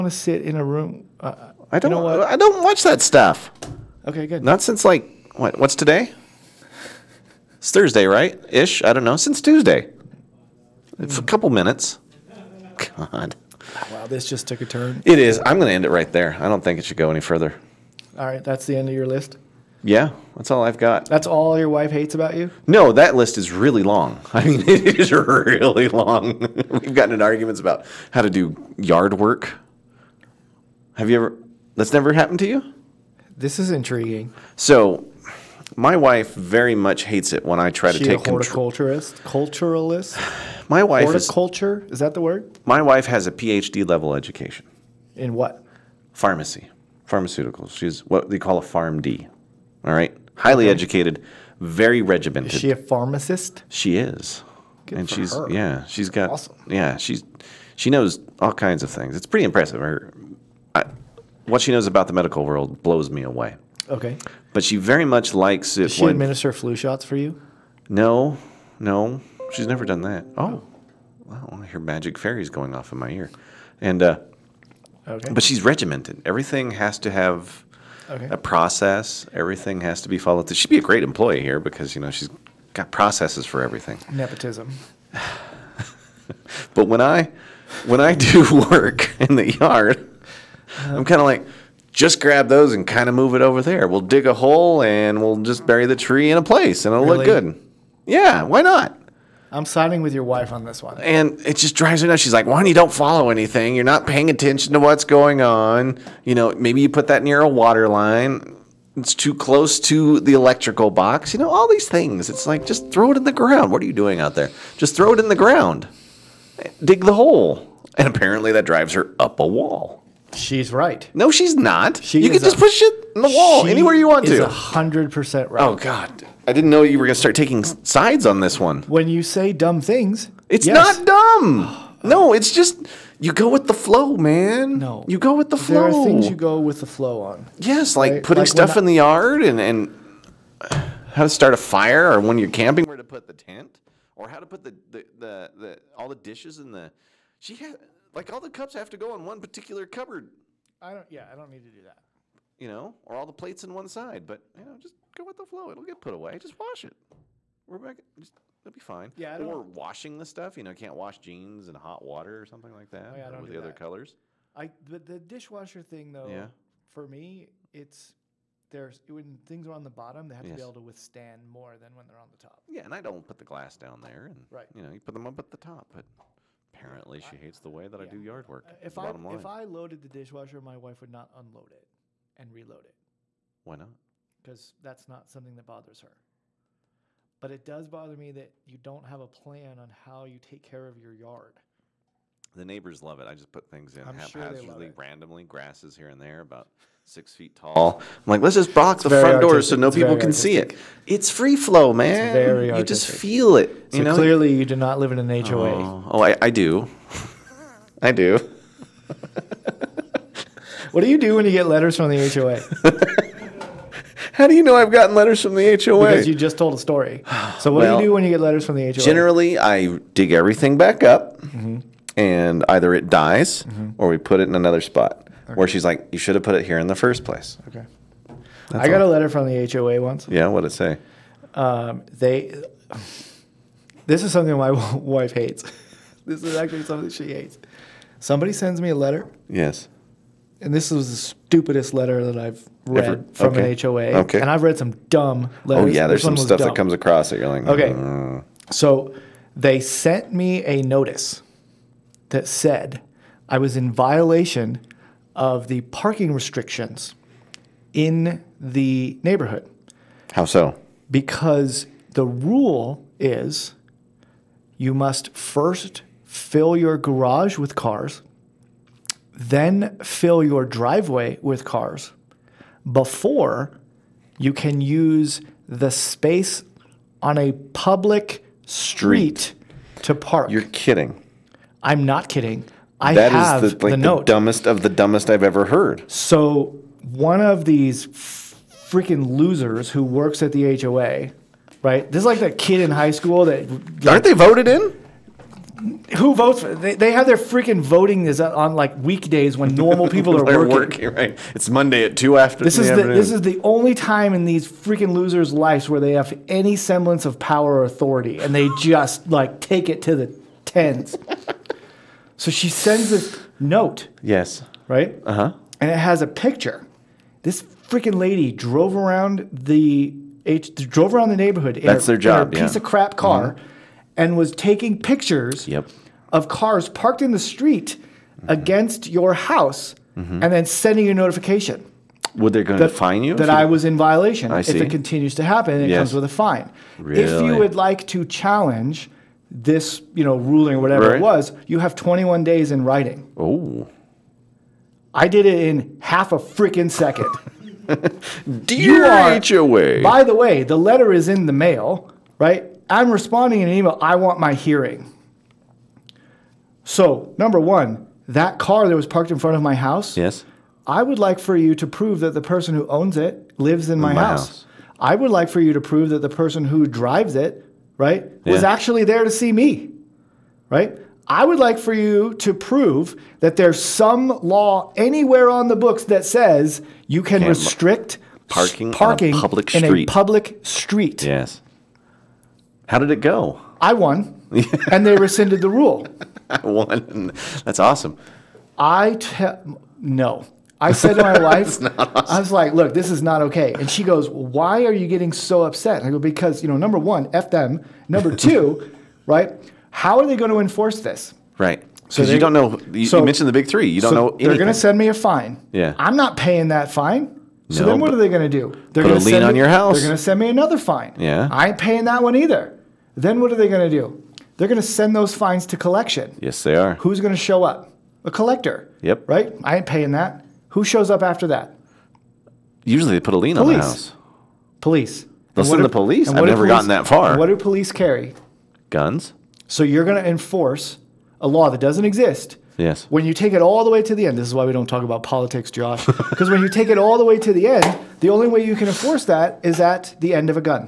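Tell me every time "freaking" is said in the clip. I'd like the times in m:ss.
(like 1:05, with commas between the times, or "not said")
4:48, 4:57, 5:04, 5:17, 5:46.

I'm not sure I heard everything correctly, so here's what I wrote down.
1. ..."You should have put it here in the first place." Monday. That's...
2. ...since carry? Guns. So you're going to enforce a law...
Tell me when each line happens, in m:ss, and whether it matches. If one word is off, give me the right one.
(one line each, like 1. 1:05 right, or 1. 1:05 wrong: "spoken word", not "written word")
1. 3:46 wrong: "Okay", not "Monday"
2. 7:07 wrong: "police", not "since".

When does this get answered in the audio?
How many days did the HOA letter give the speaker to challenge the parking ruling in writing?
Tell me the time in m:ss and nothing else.
5:41.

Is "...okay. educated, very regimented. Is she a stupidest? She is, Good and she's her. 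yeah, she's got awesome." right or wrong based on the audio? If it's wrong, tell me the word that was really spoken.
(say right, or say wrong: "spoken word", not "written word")
wrong: "pharmacist", not "stupidest".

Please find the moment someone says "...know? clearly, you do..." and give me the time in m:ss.
3:24.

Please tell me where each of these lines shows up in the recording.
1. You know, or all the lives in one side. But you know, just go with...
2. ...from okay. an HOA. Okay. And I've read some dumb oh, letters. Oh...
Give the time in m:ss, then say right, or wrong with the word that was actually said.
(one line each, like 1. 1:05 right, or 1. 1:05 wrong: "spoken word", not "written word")
1. 2:32 wrong: "plates", not "lives"
2. 4:03 right.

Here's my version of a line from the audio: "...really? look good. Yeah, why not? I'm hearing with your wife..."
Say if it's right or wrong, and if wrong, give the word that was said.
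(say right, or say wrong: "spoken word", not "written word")
wrong: "siding", not "hearing".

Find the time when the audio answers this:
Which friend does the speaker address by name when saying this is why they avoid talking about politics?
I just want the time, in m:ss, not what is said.
7:15.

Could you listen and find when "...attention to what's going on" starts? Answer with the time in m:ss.
1:44.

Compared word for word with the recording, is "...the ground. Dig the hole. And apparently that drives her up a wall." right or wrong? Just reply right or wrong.
right.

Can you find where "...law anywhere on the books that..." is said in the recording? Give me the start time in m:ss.
6:14.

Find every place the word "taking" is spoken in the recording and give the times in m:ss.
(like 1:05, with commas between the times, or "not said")
2:07, 5:24.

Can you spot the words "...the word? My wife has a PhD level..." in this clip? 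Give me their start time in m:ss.
0:42.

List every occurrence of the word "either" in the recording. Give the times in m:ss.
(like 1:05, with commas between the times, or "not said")
3:42, 6:52.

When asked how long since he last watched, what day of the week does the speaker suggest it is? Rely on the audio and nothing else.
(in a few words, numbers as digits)
Thursday.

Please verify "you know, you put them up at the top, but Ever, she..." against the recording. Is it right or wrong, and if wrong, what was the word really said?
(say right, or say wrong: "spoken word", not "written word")
wrong: "Apparently", not "Ever".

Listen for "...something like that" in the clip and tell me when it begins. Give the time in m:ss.
2:42.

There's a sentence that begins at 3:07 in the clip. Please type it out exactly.
But it does bother me that you don't have a plan on how you take care of your yard.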